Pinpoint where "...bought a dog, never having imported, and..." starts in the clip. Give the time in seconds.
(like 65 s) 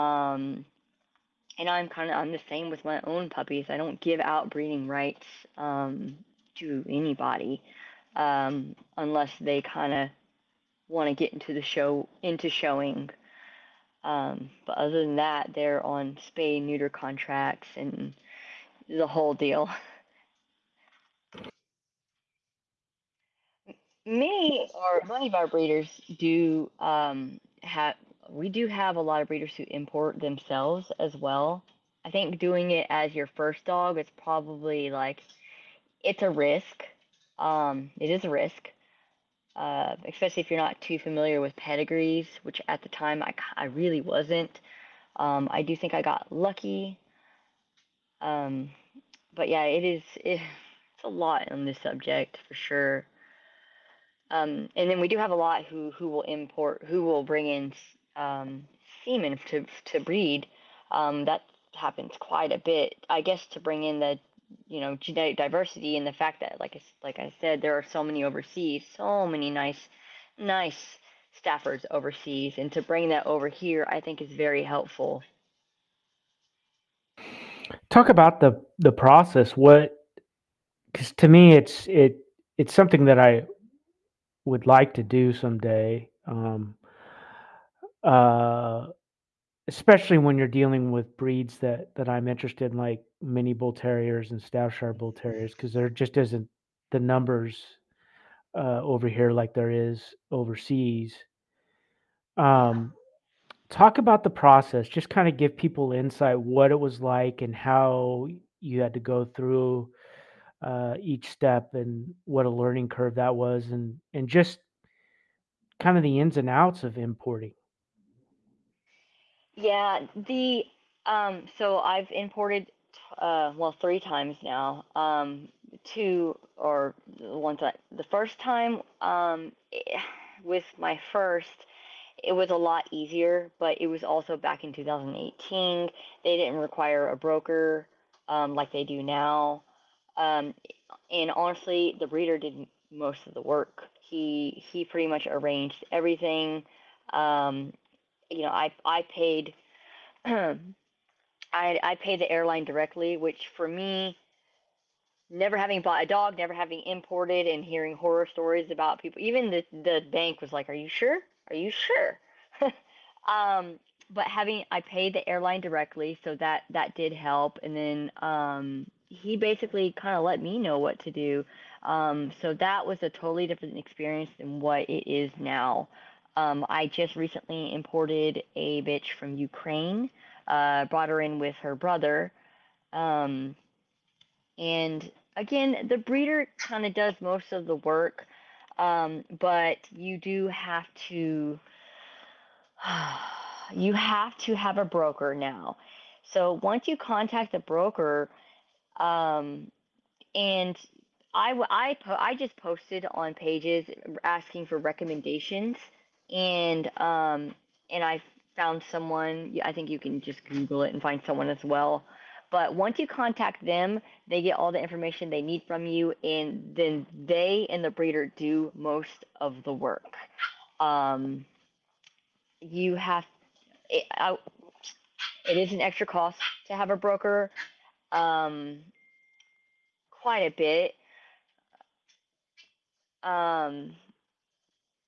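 155 s.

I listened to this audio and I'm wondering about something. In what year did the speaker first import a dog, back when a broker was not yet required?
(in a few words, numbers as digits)
2018.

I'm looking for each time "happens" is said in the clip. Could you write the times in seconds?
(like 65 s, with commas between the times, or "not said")
61 s.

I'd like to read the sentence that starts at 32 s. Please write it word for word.
I think doing it as your first dog is probably like it's a risk.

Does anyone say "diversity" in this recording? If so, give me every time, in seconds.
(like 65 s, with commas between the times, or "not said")
65 s.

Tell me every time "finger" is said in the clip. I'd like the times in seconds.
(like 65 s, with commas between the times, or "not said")
not said.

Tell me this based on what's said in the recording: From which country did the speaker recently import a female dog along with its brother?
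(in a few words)
Ukraine.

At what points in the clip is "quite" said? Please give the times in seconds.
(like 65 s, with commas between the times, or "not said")
62 s, 230 s.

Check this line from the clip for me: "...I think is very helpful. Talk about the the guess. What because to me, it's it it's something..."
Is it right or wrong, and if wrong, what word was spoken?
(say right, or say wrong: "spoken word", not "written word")
wrong: "process", not "guess".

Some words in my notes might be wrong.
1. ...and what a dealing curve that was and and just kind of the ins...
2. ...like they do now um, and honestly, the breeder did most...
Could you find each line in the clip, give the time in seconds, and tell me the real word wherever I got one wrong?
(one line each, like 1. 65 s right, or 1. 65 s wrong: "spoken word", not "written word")
1. 111 s wrong: "learning", not "dealing"
2. 138 s right.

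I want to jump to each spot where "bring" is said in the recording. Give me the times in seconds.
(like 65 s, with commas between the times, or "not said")
57 s, 63 s, 72 s.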